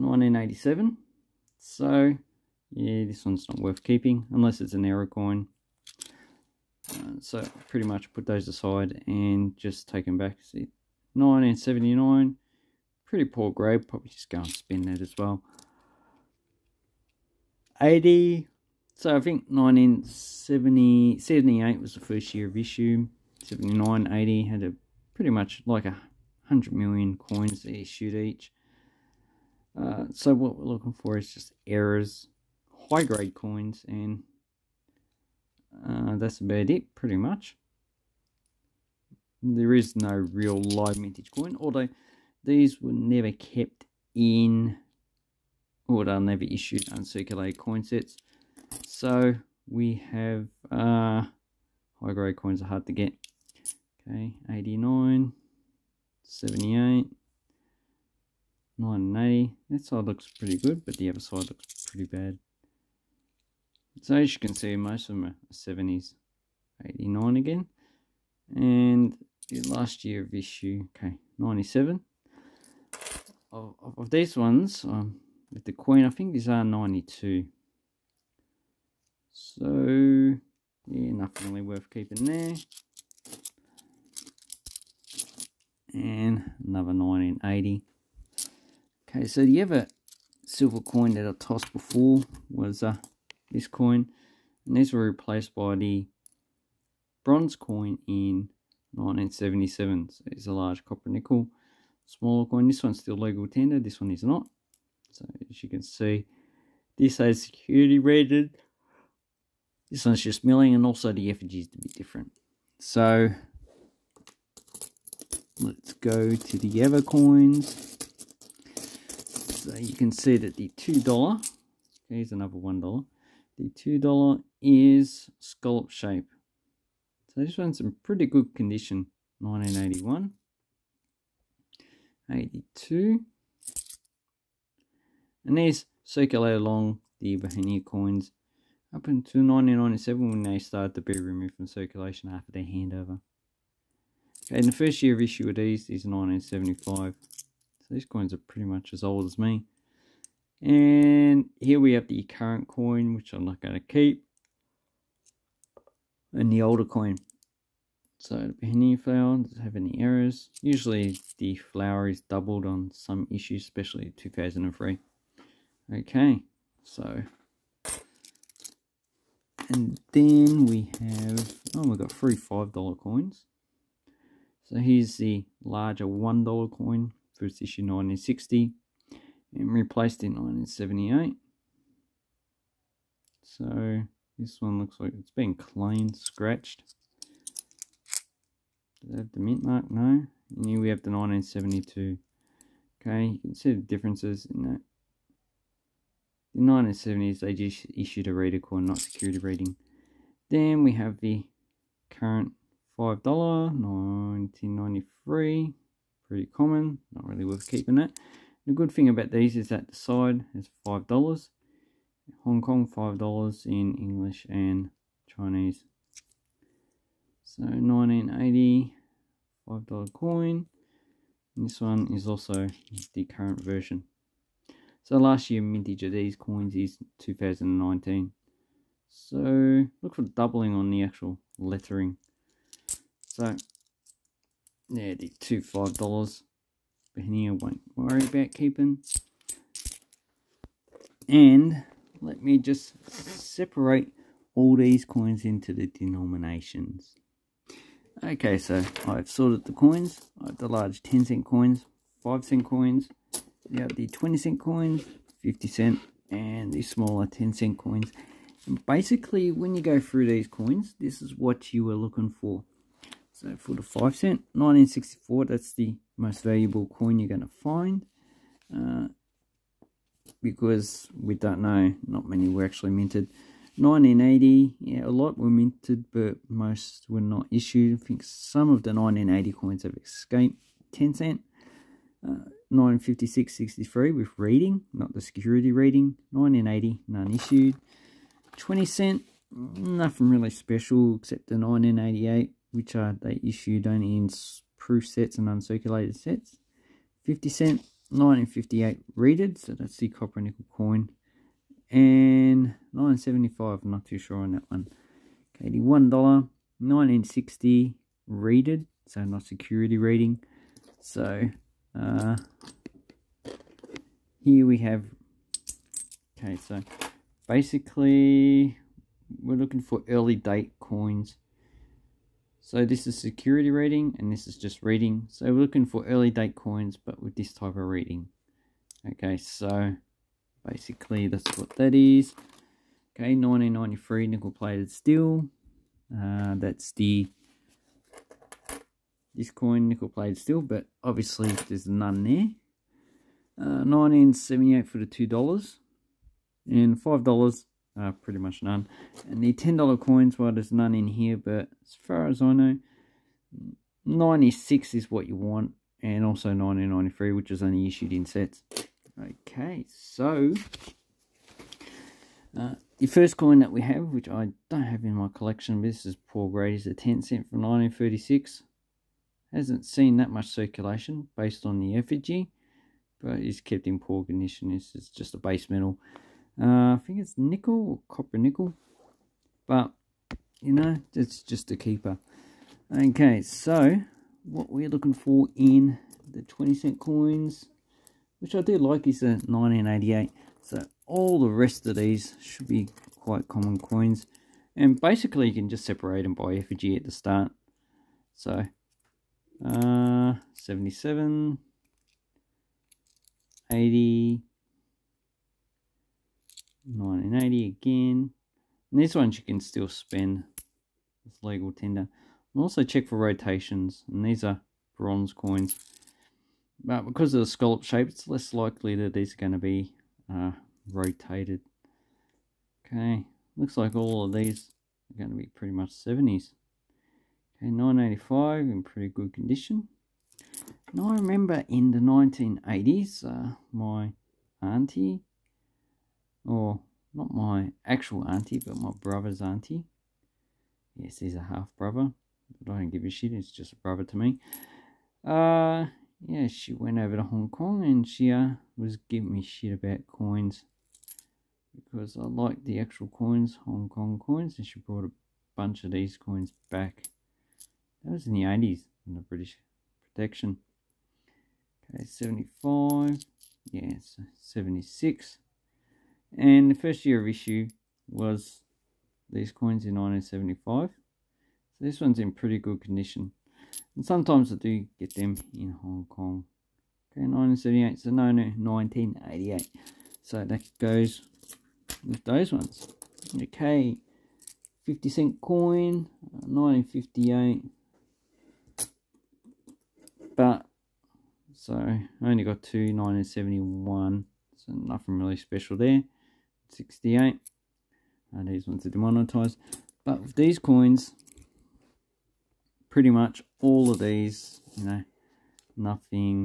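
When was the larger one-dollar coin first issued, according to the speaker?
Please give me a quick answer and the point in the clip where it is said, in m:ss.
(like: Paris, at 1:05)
1960, at 2:57.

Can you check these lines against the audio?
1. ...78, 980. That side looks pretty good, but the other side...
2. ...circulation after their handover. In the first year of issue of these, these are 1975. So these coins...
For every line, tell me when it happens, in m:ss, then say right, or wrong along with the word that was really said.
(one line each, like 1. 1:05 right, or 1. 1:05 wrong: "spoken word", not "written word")
1. 0:56 right
2. 2:21 right.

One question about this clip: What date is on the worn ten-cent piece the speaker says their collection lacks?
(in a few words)
1936.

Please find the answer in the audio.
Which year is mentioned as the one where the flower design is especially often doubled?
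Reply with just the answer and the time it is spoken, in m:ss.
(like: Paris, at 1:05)
2003, at 2:44.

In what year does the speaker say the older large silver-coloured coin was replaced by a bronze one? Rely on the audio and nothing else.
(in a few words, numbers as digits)
1977.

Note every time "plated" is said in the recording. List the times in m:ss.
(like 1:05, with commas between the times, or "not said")
5:34, 5:40.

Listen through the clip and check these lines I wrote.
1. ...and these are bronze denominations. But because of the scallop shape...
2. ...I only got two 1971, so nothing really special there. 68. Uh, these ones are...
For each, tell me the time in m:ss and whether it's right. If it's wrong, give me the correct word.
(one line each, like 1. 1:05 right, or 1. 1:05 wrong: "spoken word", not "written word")
1. 6:54 wrong: "coins", not "denominations"
2. 8:11 right.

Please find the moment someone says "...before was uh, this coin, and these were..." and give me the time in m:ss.
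1:31.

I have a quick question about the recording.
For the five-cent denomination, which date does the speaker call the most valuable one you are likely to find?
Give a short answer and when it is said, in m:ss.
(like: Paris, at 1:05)
1964, at 4:24.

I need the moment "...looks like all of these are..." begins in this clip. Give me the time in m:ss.
7:03.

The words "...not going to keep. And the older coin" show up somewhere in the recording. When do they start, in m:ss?
2:33.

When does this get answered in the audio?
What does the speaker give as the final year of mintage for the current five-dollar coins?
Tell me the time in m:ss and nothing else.
3:47.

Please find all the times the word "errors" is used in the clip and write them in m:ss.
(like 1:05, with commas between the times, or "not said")
0:04, 0:31, 2:39.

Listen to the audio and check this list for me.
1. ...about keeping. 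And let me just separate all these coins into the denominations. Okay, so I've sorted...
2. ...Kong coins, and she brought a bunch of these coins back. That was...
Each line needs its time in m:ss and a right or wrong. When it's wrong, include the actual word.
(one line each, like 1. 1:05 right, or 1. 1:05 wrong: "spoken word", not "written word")
1. 3:58 right
2. 7:33 right.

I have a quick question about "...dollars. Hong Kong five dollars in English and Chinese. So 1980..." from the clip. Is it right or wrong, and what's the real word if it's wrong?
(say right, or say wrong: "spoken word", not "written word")
right.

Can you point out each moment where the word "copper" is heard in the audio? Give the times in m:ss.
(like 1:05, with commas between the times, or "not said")
1:40, 5:00, 6:18.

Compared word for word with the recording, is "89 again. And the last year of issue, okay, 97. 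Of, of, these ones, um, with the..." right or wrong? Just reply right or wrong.
right.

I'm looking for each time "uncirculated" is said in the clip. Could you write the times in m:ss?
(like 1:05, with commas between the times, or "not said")
0:46, 4:55.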